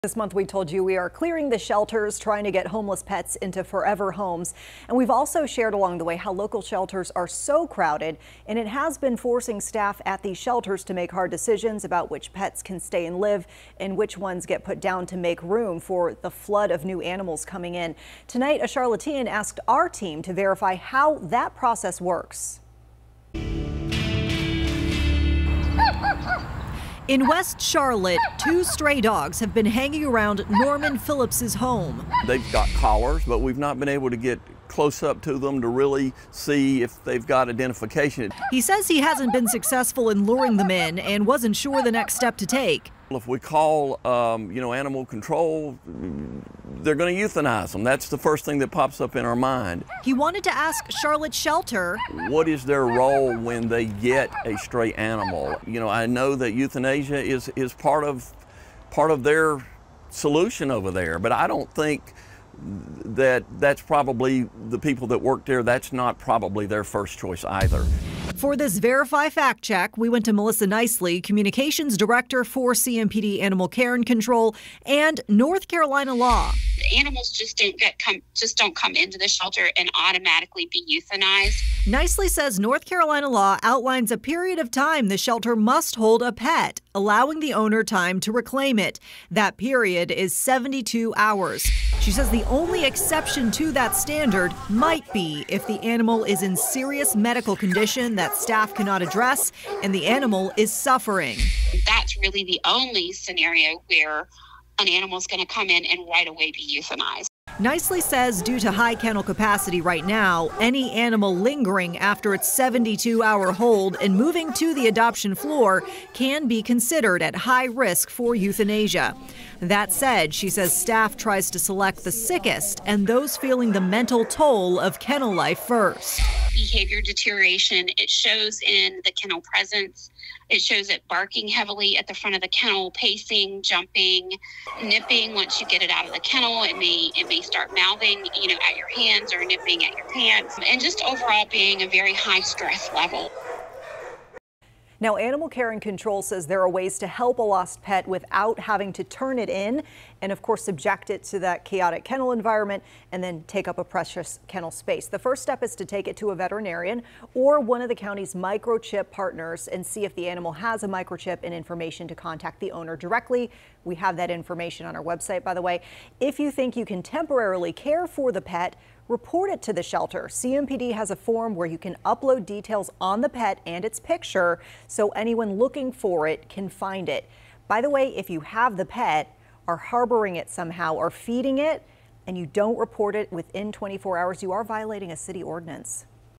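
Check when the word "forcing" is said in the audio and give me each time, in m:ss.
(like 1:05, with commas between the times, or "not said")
0:09.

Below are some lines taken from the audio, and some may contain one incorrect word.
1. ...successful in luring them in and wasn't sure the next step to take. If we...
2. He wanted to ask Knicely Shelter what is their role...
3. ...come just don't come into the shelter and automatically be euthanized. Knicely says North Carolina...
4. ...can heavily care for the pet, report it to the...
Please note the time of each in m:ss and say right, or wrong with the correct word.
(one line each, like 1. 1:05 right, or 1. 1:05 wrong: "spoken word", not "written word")
1. 0:39 right
2. 0:50 wrong: "Charlotte", not "Knicely"
3. 1:17 right
4. 2:46 wrong: "temporarily", not "heavily".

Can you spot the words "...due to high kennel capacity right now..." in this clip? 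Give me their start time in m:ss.
1:48.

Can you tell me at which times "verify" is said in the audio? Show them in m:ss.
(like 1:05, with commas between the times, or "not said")
0:20, 1:08.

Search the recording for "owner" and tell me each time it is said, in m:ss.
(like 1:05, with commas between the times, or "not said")
1:27, 2:42.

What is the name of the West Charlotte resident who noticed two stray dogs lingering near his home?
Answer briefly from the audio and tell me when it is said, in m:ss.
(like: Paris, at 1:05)
Norman Phillips, at 0:30.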